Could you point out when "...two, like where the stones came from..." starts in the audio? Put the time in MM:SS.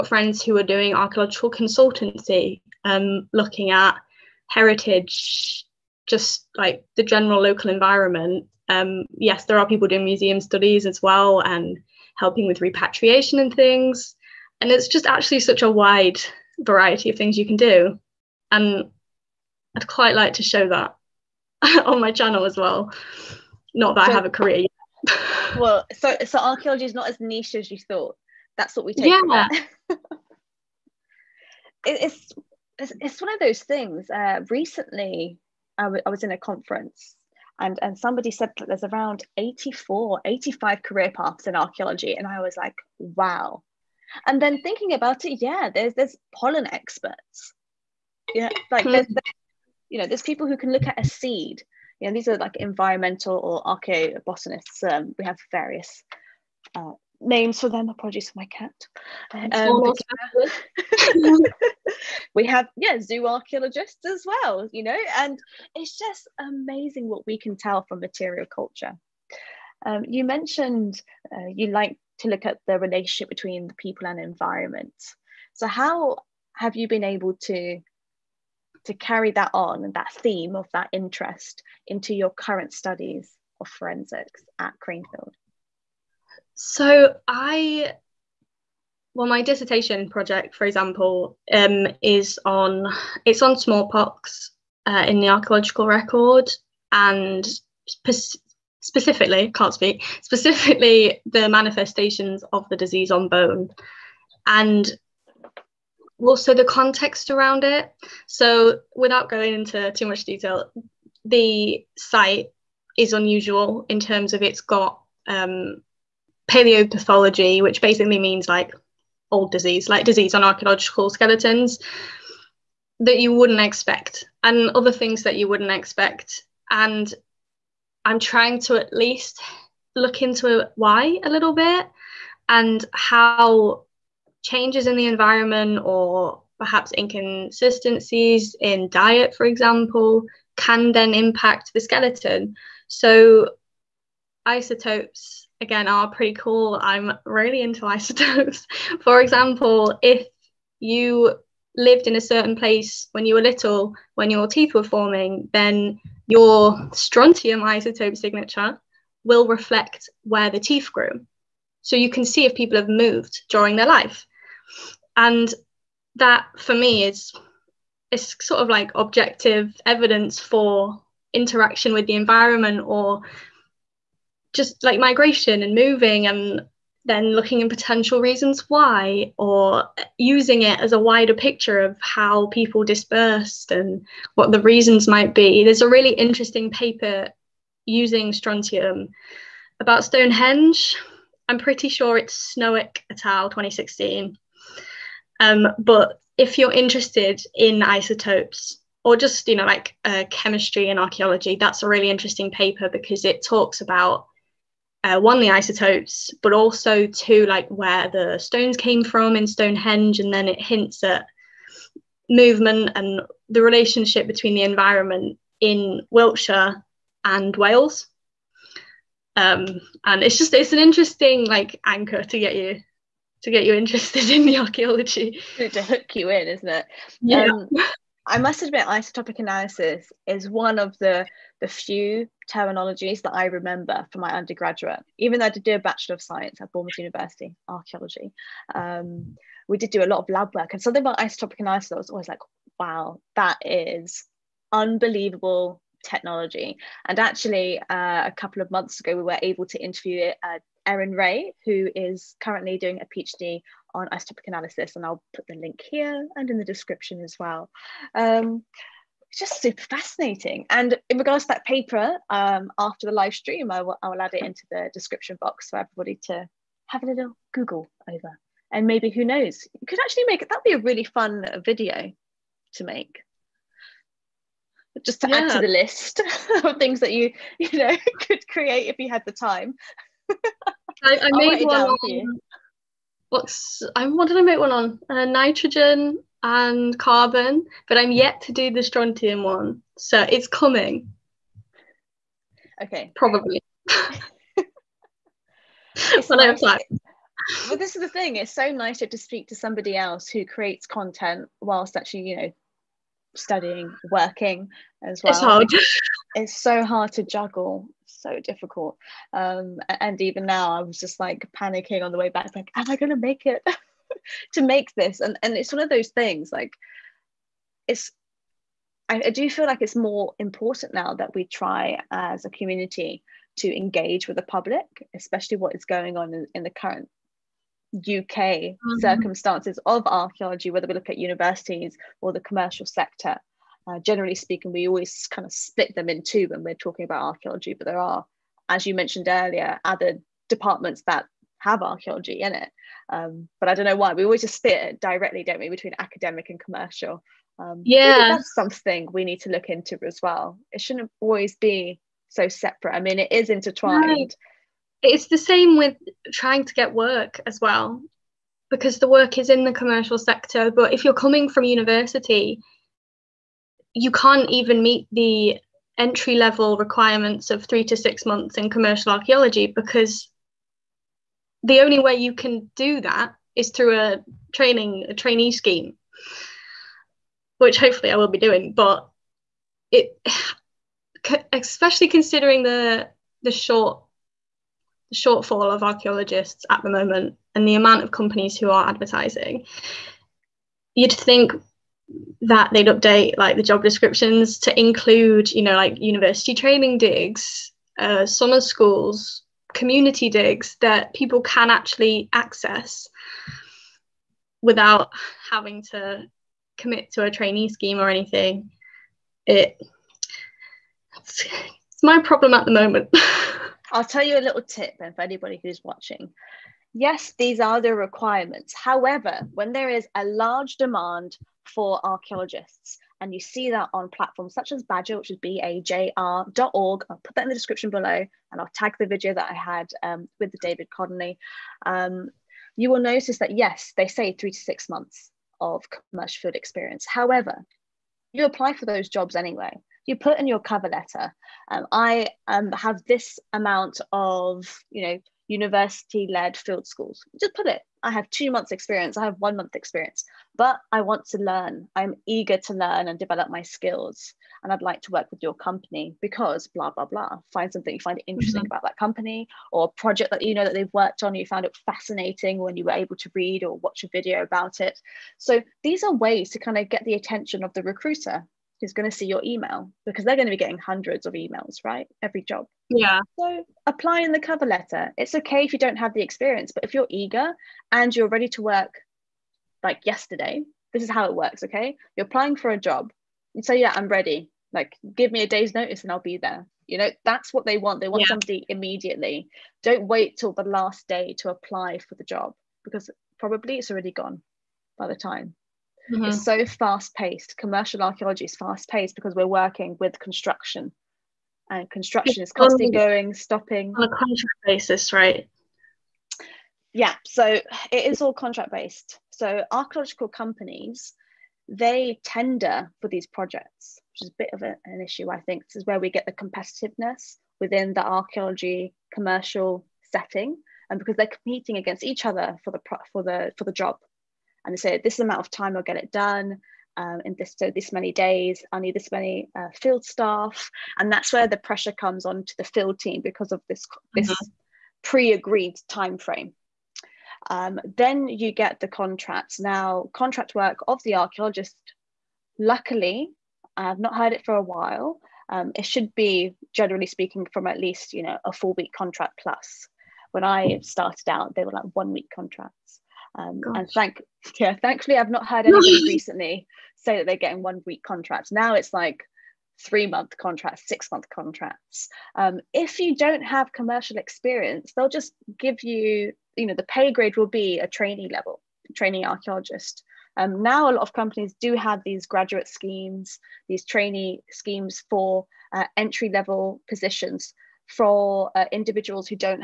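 03:27.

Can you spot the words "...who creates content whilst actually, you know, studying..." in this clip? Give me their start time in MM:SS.
05:00.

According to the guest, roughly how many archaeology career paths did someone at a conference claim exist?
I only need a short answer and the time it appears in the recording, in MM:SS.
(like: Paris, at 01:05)
84-85, at 00:39.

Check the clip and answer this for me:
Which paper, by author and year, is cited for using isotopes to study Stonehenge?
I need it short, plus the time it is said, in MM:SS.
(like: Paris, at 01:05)
Snoeck et al 2016, at 03:12.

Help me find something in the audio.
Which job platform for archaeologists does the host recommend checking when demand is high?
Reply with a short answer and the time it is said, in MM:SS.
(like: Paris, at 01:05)
Badger, at 07:04.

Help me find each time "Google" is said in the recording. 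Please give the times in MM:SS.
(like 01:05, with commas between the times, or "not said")
04:27.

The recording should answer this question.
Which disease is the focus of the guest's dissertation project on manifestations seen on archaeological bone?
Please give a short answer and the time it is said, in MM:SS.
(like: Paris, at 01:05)
Smallpox, at 01:33.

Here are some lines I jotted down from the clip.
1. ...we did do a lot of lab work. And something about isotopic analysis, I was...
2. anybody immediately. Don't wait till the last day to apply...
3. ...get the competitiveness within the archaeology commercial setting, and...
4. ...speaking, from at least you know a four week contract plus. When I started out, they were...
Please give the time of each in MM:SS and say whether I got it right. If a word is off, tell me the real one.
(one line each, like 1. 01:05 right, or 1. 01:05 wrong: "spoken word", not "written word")
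1. 03:59 right
2. 08:08 wrong: "somebody", not "anybody"
3. 08:36 right
4. 09:07 right.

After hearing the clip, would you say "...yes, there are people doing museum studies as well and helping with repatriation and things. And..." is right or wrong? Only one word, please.
right.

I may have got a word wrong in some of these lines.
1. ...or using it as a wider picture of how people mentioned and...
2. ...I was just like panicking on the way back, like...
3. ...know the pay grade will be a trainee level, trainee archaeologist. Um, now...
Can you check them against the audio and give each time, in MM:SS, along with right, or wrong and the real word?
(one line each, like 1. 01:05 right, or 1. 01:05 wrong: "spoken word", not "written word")
1. 02:59 wrong: "dispersed", not "mentioned"
2. 05:10 right
3. 09:26 right.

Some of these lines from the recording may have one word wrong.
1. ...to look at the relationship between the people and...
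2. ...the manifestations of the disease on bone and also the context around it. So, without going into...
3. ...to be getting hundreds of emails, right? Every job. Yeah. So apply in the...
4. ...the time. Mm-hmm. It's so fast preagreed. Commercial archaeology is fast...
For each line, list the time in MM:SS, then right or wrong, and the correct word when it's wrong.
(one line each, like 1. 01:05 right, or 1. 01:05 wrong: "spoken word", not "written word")
1. 01:12 right
2. 01:41 right
3. 07:50 right
4. 08:15 wrong: "paced", not "preagreed".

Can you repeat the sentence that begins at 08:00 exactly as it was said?
This is how it works, okay?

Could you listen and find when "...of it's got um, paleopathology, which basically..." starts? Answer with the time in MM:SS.
01:54.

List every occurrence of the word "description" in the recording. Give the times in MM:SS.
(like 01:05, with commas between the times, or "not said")
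04:16, 04:24, 06:33, 07:07.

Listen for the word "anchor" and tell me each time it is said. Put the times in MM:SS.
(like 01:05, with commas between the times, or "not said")
03:41.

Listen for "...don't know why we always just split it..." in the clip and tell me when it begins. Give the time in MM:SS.
05:43.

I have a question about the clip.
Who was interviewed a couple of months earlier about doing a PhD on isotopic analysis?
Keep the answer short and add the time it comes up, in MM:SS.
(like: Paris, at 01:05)
Erin Ray, at 04:10.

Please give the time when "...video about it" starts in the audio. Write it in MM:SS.
07:44.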